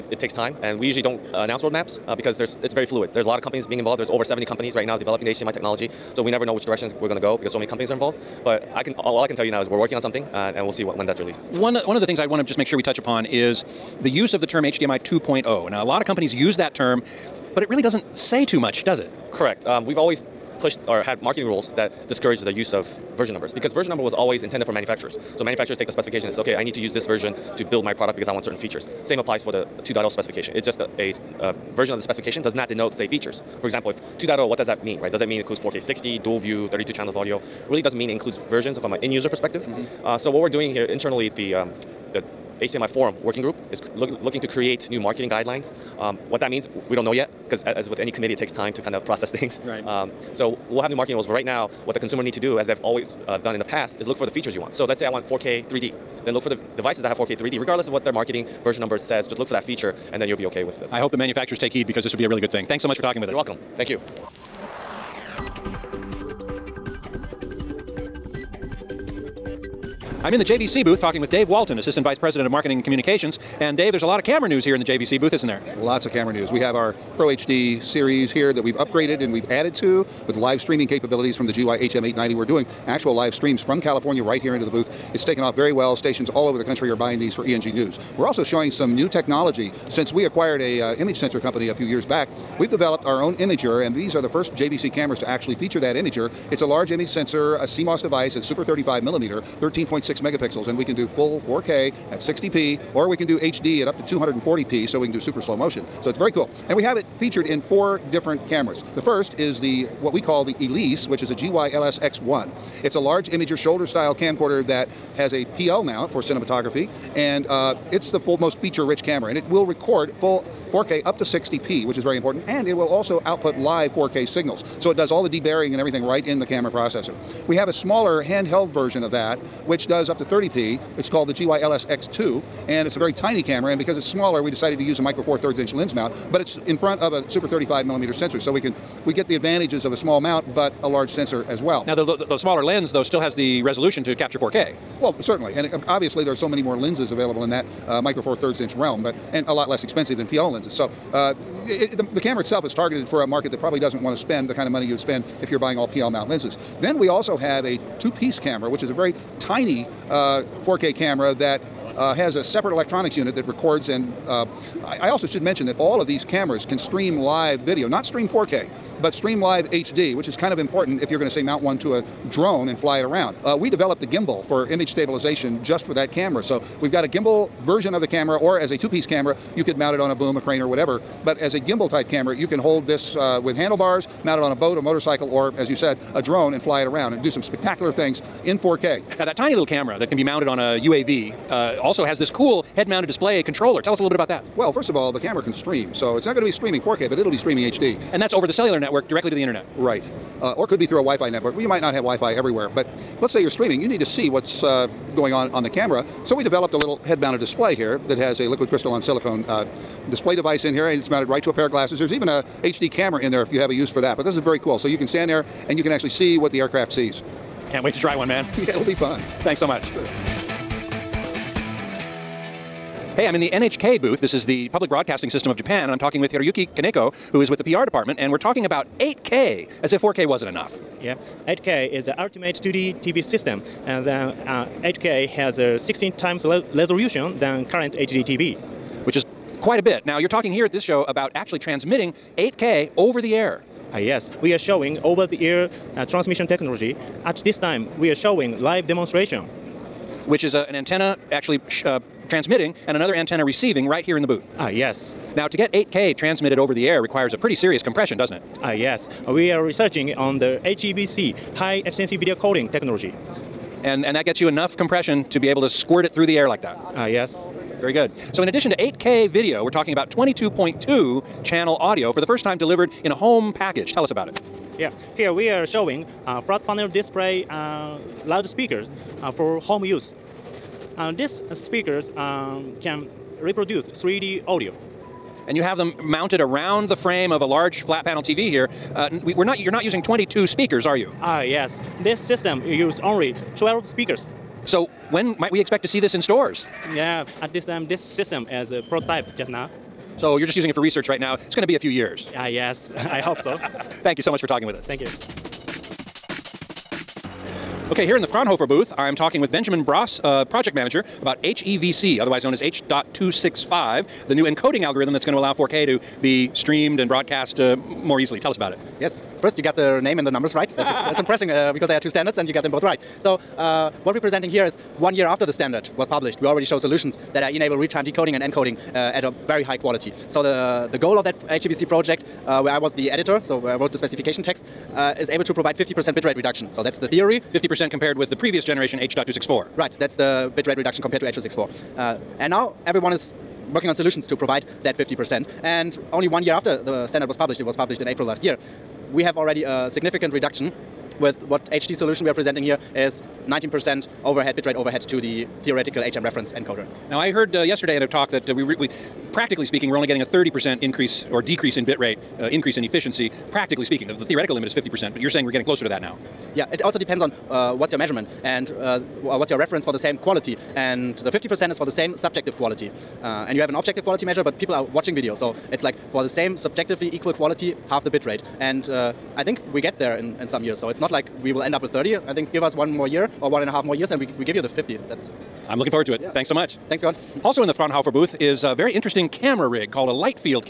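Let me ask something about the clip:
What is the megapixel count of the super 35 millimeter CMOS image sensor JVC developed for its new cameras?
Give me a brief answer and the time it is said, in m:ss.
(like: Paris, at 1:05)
13.6 megapixels, at 1:39.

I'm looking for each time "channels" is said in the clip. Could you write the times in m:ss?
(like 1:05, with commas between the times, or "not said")
0:36, 4:31.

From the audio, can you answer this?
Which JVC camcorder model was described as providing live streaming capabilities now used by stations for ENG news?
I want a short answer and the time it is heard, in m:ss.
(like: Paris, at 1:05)
GY HM890, at 1:21.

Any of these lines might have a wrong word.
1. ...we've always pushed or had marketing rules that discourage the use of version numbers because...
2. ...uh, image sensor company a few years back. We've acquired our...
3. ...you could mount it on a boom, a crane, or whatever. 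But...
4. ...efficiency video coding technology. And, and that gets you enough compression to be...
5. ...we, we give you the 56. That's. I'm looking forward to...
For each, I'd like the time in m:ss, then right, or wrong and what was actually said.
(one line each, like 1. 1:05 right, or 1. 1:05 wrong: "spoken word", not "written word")
1. 0:19 right
2. 1:30 wrong: "developed", not "acquired"
3. 2:59 right
4. 4:21 right
5. 6:24 wrong: "50", not "56".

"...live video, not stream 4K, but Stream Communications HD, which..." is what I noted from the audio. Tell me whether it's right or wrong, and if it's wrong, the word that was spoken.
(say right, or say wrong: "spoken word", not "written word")
wrong: "Live", not "Communications".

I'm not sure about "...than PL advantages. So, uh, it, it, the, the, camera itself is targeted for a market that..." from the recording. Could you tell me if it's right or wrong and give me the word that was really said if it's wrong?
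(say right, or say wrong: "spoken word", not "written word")
wrong: "lenses", not "advantages".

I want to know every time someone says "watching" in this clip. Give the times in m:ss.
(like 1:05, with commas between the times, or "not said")
6:14.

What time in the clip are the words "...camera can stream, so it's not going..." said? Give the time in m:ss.
3:15.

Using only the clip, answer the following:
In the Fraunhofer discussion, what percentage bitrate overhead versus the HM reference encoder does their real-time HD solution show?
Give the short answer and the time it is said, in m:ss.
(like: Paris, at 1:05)
19%, at 5:53.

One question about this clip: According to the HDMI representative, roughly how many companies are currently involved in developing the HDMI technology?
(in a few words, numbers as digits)
over 70.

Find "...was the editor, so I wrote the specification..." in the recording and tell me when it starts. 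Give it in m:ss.
5:32.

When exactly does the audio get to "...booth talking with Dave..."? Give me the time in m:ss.
1:10.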